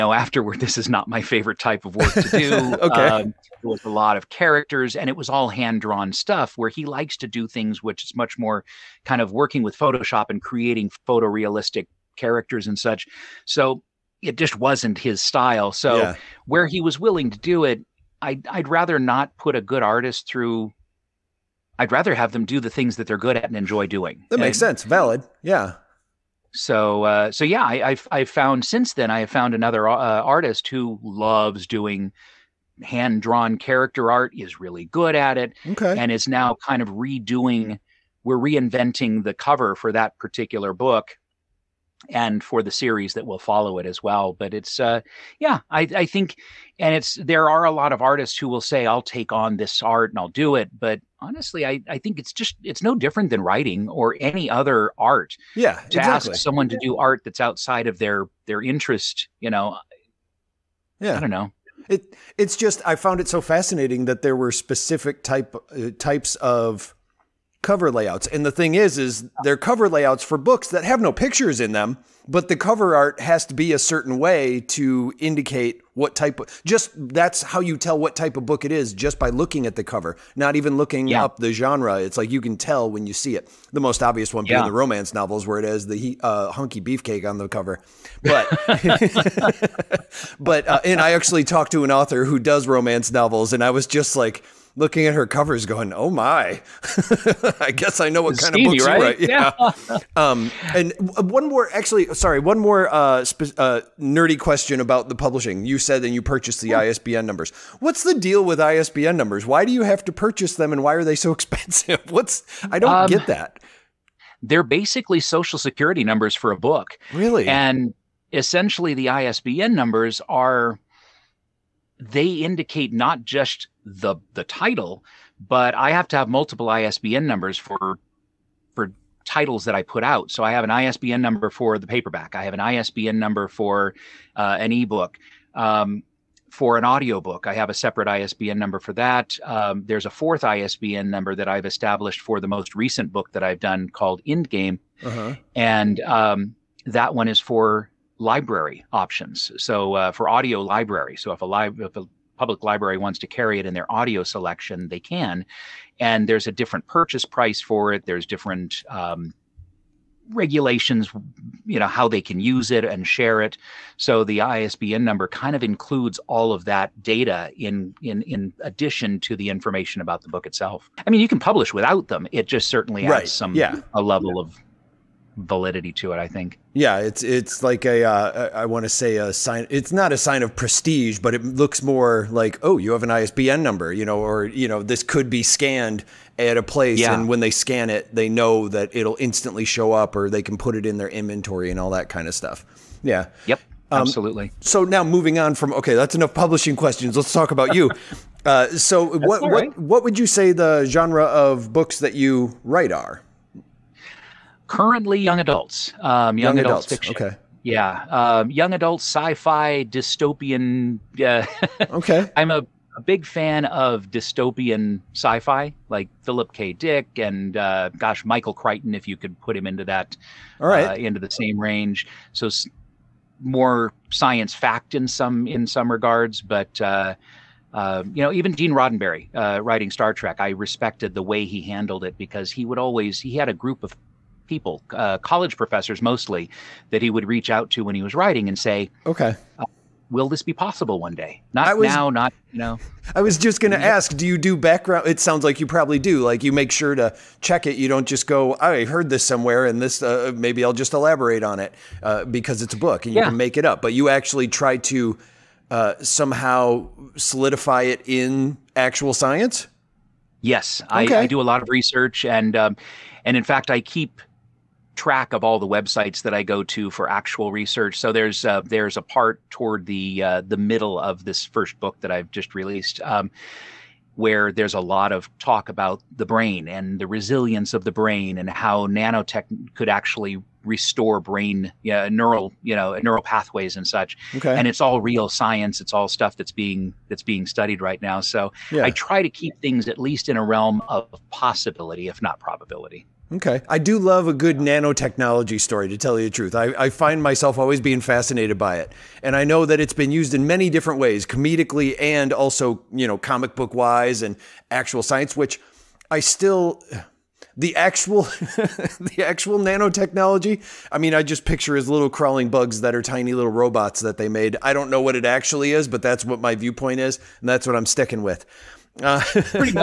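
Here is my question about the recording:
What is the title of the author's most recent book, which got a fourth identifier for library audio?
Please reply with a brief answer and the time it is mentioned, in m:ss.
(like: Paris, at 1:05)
indGame, at 2:24.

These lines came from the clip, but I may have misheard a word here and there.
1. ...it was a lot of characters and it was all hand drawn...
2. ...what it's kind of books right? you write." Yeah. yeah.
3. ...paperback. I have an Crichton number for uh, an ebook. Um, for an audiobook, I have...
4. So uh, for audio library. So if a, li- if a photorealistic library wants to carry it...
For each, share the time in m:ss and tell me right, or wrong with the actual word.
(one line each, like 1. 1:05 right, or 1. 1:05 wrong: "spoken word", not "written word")
1. 0:03 right
2. 1:38 right
3. 2:11 wrong: "ISBN", not "Crichton"
4. 2:29 wrong: "public", not "photorealistic".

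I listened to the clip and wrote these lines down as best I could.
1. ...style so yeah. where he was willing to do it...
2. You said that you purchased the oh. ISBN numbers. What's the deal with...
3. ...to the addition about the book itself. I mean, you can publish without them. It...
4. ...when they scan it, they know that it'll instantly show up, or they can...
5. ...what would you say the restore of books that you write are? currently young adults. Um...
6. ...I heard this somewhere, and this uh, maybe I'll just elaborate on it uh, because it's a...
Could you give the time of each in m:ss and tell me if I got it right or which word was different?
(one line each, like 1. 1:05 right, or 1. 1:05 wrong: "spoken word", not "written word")
1. 0:15 right
2. 1:45 right
3. 2:49 wrong: "information", not "addition"
4. 3:07 right
5. 3:19 wrong: "genre", not "restore"
6. 4:08 right.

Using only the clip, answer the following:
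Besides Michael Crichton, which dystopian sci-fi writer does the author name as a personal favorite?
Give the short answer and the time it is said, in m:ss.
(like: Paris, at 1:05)
Philip K. Dick, at 3:36.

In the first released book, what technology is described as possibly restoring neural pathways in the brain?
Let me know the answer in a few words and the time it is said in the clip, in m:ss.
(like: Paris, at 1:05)
Nanotech, at 4:38.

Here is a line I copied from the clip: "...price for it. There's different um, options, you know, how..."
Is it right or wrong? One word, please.
wrong.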